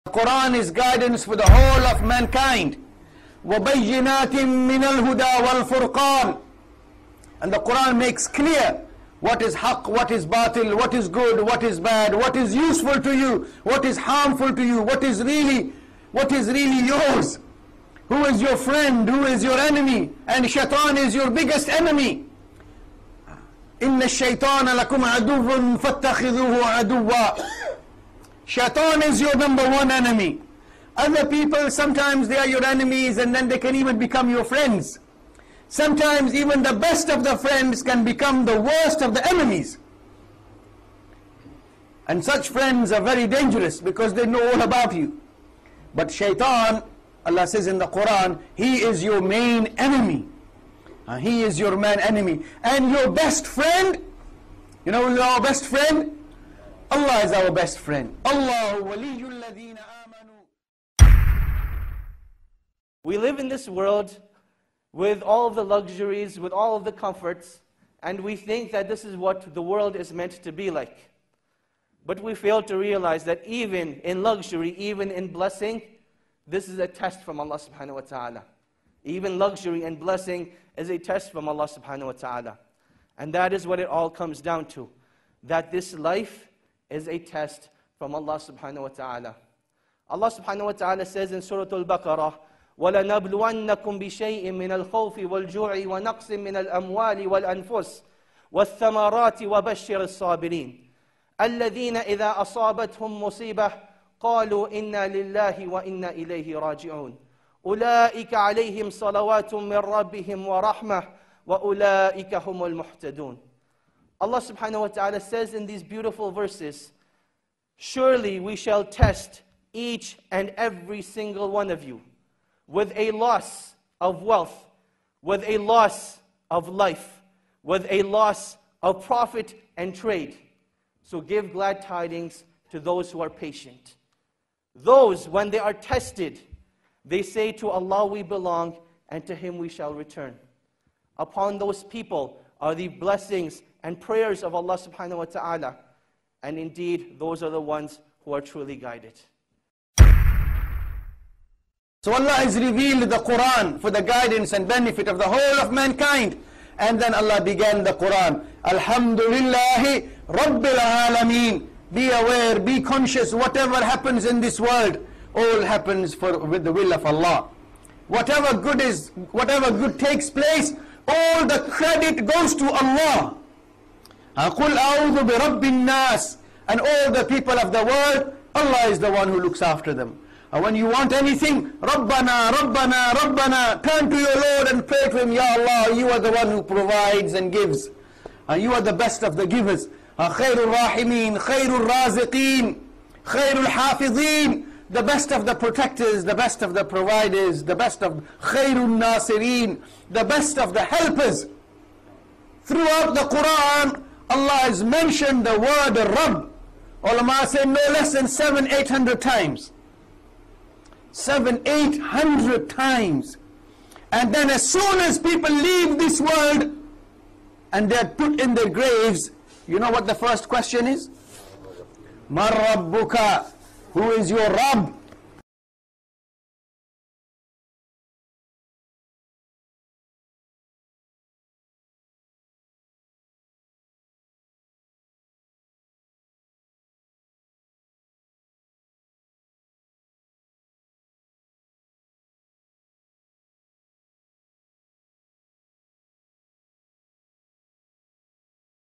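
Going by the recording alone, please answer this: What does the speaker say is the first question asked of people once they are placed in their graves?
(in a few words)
Man Rabbuka.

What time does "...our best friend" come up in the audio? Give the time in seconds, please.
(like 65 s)
57 s.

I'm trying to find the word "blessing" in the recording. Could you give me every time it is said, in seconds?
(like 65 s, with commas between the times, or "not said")
75 s, 79 s, 142 s.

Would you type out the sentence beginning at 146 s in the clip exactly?
And indeed, those are the ones who are truly guided.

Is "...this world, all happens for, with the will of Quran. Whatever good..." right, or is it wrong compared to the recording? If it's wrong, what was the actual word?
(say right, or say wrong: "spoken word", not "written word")
wrong: "Allah", not "Quran".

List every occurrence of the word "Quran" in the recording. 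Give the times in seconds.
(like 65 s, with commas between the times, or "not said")
0 s, 7 s, 47 s, 153 s, 157 s, 203 s.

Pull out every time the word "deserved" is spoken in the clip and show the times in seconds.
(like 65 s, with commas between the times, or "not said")
not said.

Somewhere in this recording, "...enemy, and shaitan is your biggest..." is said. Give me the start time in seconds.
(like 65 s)
19 s.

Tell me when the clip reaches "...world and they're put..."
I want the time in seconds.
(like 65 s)
216 s.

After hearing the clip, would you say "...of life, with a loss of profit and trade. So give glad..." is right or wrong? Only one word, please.
right.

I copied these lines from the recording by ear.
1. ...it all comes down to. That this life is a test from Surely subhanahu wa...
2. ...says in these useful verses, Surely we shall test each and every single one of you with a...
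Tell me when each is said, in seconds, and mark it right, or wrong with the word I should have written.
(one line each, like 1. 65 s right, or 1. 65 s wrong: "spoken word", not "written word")
1. 83 s wrong: "Allah", not "Surely"
2. 115 s wrong: "beautiful", not "useful".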